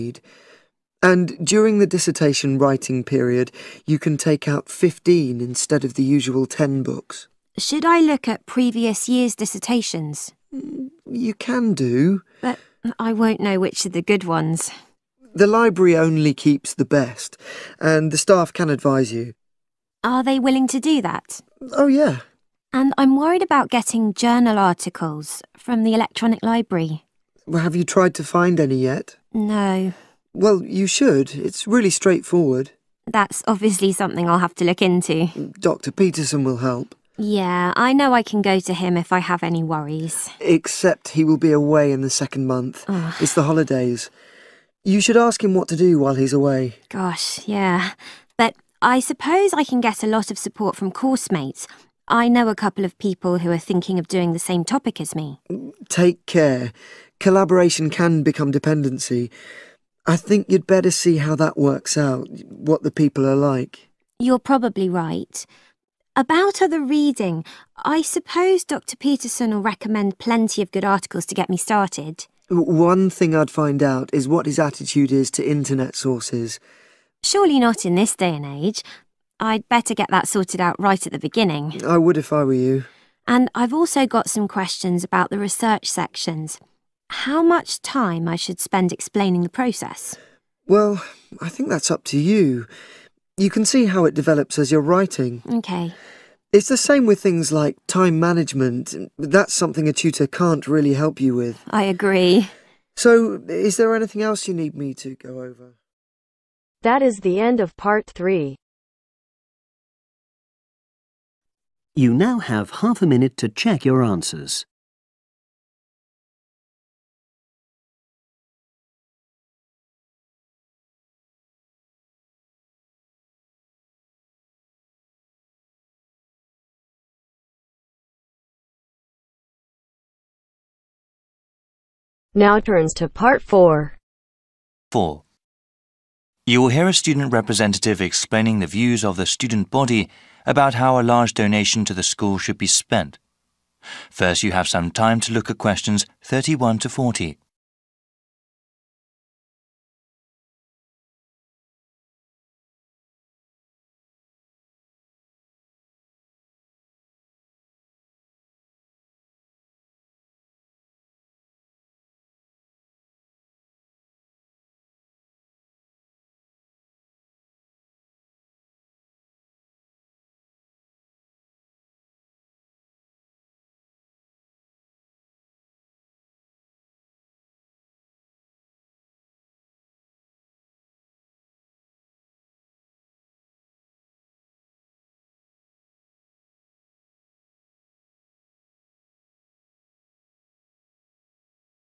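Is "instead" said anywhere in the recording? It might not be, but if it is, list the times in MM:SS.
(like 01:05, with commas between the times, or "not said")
00:05.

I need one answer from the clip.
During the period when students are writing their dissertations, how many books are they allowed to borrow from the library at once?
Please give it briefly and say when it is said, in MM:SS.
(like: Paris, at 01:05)
15, at 00:04.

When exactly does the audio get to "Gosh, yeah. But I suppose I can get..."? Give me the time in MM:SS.
00:46.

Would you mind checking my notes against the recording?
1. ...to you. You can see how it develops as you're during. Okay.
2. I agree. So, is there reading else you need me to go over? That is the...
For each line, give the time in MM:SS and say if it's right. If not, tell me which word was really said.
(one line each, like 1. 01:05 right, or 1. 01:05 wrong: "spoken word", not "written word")
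1. 01:32 wrong: "writing", not "during"
2. 01:41 wrong: "anything", not "reading".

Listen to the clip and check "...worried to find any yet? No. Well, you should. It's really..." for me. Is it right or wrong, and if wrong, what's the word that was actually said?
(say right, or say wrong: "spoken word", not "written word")
wrong: "tried", not "worried".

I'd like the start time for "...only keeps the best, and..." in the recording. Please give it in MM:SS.
00:15.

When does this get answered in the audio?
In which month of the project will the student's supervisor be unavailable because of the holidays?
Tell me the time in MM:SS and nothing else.
00:42.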